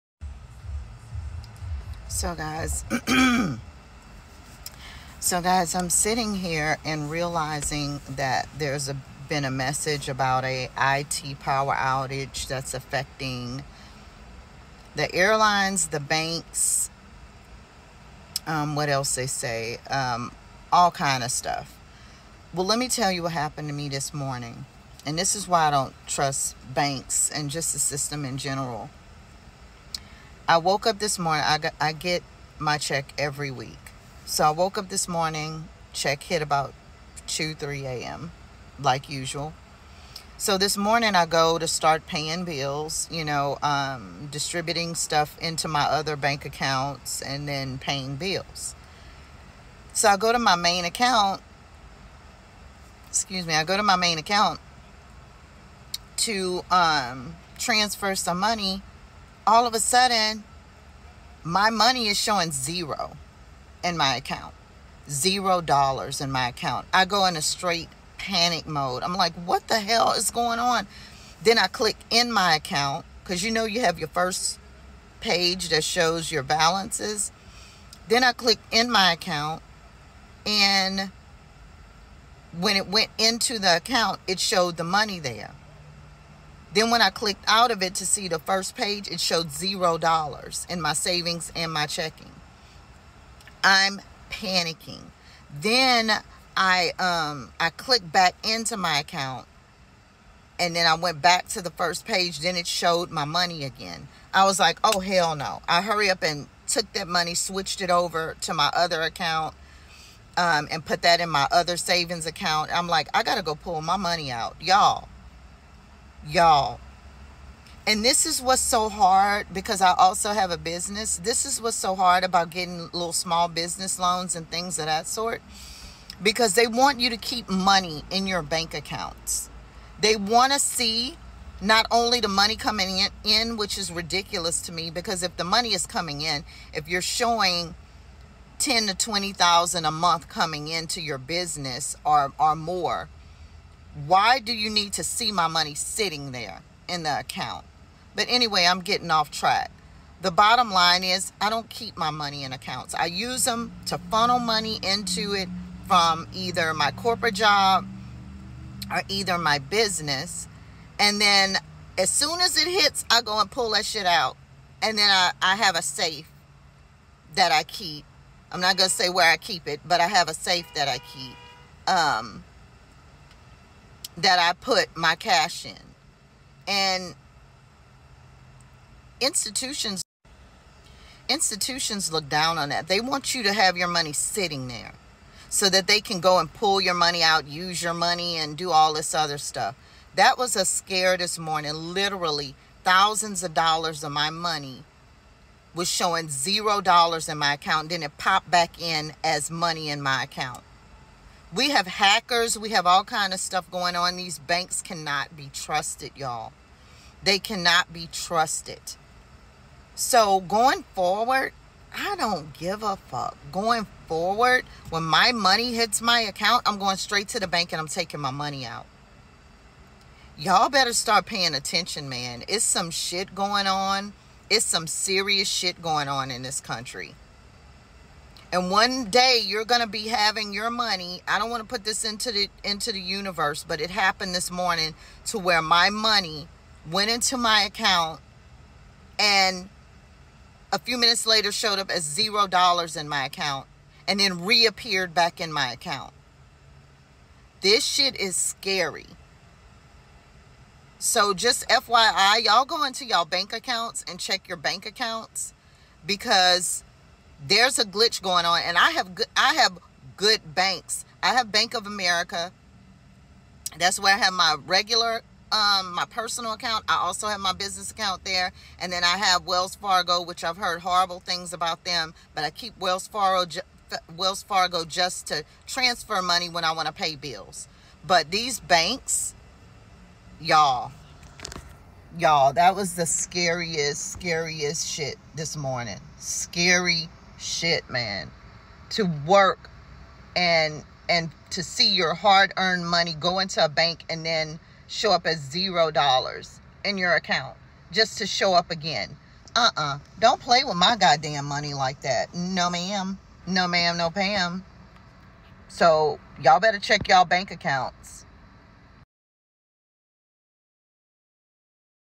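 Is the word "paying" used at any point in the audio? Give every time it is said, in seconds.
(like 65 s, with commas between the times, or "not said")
42 s, 47 s, 221 s.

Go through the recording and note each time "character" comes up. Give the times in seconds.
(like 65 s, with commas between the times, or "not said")
not said.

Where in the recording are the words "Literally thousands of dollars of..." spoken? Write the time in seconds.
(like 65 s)
191 s.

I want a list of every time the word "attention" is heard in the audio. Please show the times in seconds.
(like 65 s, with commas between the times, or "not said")
221 s.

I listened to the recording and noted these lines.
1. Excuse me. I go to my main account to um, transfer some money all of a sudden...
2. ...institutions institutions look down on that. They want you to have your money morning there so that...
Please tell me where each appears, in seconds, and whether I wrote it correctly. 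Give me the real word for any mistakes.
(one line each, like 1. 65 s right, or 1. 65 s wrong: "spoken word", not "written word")
1. 53 s right
2. 179 s wrong: "sitting", not "morning".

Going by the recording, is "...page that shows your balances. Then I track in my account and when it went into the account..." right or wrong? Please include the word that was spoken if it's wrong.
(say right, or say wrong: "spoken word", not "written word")
wrong: "click", not "track".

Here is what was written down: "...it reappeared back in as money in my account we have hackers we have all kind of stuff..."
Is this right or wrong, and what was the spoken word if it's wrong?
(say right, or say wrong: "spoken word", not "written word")
wrong: "popped", not "reappeared".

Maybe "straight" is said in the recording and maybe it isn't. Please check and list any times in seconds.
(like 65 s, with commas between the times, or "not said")
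67 s, 216 s.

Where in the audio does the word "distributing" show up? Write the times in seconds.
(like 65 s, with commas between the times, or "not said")
44 s.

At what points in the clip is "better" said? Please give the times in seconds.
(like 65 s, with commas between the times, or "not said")
220 s, 306 s.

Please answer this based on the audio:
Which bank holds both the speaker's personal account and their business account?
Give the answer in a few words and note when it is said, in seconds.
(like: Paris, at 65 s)
Bank of America, at 261 s.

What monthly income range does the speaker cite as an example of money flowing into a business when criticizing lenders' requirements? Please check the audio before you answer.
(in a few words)
10 to 20,000.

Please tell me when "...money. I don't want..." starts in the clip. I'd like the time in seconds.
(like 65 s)
230 s.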